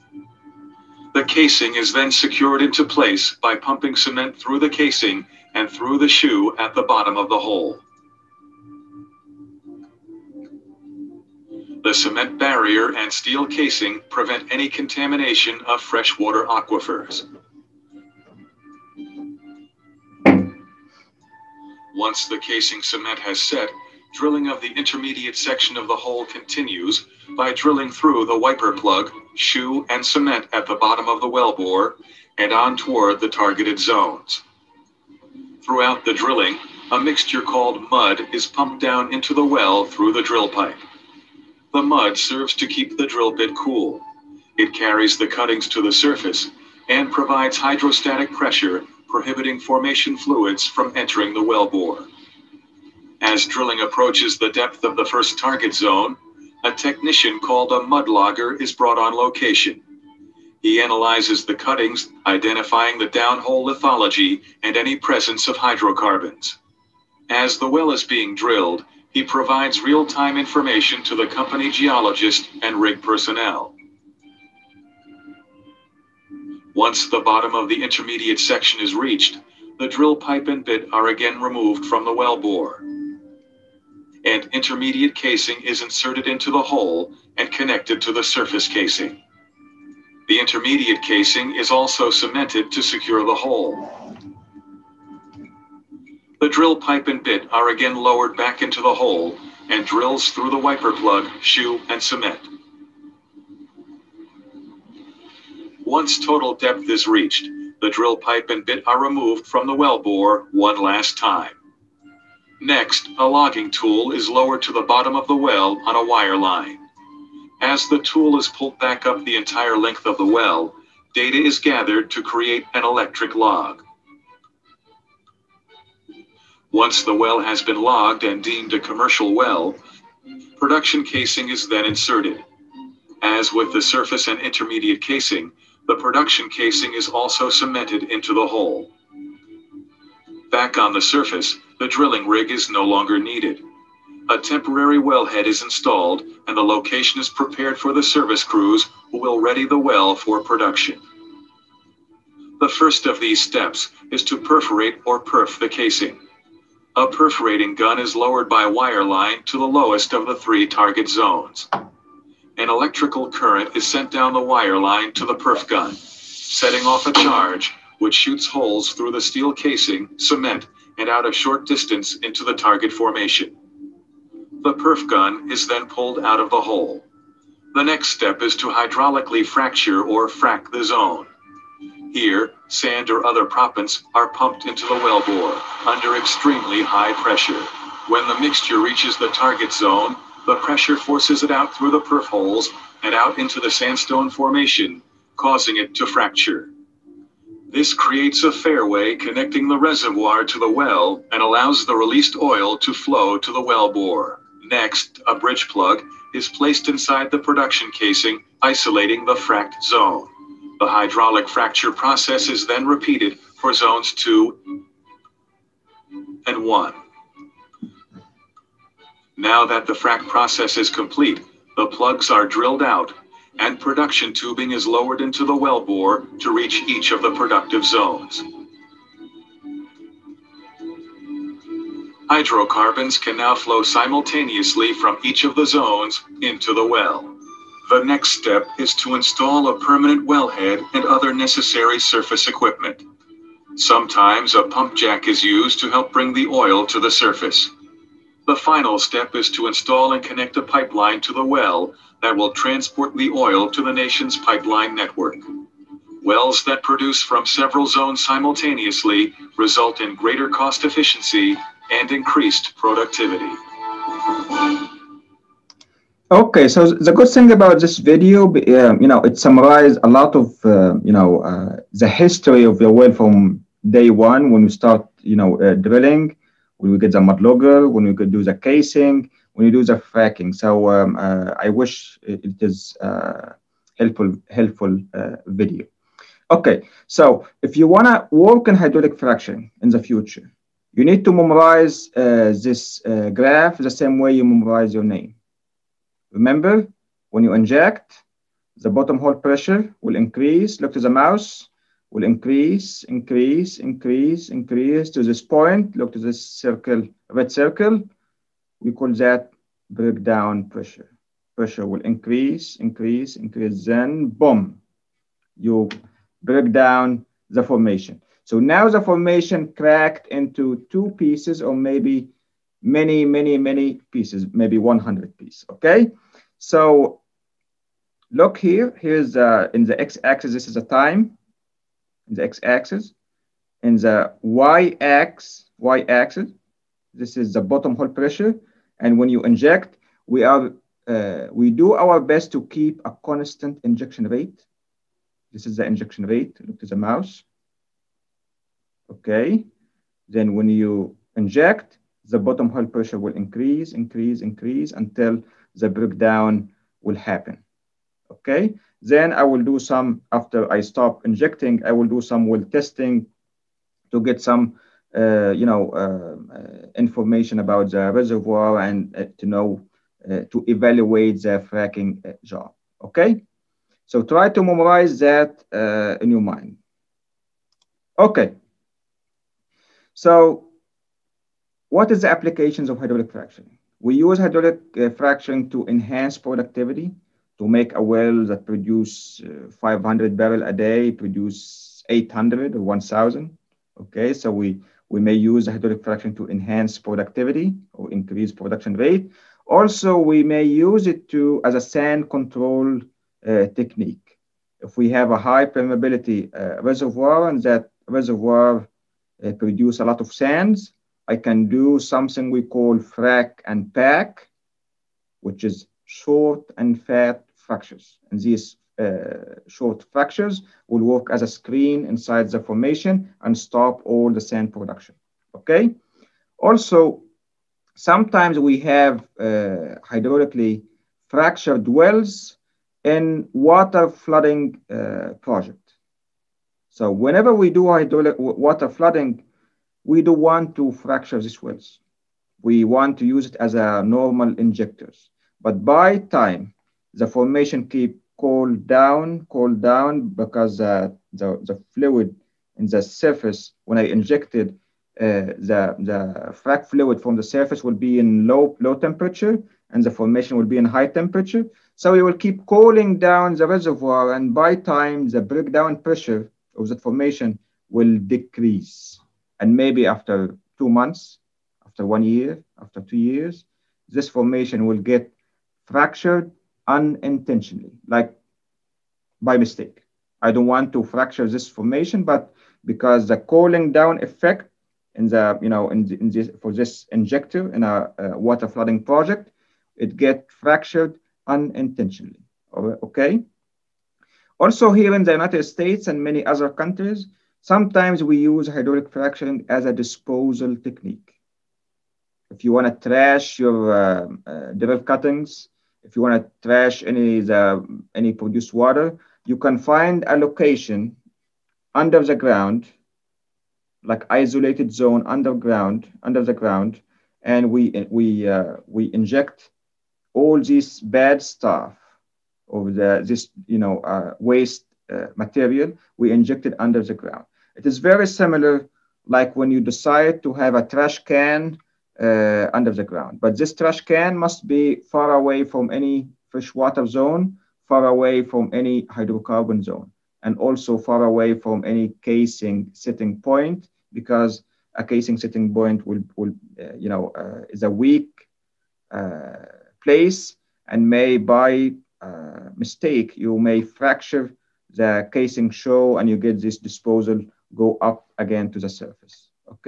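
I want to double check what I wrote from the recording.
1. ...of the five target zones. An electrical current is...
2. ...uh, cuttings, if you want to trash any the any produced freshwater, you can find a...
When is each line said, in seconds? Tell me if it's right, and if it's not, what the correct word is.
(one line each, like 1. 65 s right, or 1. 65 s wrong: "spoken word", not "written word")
1. 160 s wrong: "three", not "five"
2. 504 s wrong: "water", not "freshwater".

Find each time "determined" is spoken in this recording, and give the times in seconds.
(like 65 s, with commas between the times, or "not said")
not said.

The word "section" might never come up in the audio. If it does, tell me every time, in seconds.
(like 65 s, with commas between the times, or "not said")
25 s, 78 s.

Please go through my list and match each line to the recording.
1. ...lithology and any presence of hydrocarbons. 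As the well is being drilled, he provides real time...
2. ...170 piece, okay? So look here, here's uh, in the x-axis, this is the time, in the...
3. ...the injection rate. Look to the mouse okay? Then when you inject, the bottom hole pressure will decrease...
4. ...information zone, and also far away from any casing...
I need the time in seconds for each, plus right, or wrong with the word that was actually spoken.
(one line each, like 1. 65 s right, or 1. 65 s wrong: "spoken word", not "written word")
1. 63 s right
2. 324 s wrong: "100", not "170"
3. 345 s wrong: "increase", not "decrease"
4. 539 s wrong: "hydrocarbon", not "information".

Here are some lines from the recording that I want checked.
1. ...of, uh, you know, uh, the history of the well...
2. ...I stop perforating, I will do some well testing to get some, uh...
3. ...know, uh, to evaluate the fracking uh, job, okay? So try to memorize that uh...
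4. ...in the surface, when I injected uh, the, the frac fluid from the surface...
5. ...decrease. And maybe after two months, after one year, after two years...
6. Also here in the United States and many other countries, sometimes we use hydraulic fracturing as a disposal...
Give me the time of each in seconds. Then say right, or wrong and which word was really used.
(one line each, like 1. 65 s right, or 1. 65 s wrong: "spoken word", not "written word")
1. 270 s right
2. 360 s wrong: "injecting", not "perforating"
3. 369 s right
4. 452 s right
5. 468 s right
6. 494 s right.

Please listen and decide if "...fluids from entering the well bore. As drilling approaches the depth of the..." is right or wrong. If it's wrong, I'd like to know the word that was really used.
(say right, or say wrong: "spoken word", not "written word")
right.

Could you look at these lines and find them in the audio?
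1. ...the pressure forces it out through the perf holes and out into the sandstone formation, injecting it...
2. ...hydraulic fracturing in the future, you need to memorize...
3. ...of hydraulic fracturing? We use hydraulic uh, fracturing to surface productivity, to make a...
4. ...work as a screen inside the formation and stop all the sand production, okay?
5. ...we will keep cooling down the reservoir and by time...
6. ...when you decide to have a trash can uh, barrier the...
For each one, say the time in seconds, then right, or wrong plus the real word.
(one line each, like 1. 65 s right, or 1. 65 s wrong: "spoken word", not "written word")
1. 190 s wrong: "causing", not "injecting"
2. 288 s right
3. 382 s wrong: "enhance", not "surface"
4. 421 s right
5. 462 s right
6. 529 s wrong: "under", not "barrier".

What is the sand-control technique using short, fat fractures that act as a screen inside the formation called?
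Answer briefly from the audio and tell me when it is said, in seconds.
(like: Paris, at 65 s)
frac and pack, at 412 s.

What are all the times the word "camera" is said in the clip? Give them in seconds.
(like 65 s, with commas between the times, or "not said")
not said.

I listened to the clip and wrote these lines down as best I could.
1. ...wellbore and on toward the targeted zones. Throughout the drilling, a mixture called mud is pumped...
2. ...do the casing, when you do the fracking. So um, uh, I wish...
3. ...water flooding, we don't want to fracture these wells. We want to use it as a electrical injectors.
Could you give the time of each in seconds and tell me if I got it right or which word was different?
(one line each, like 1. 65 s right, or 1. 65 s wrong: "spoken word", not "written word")
1. 31 s right
2. 278 s right
3. 438 s wrong: "normal", not "electrical".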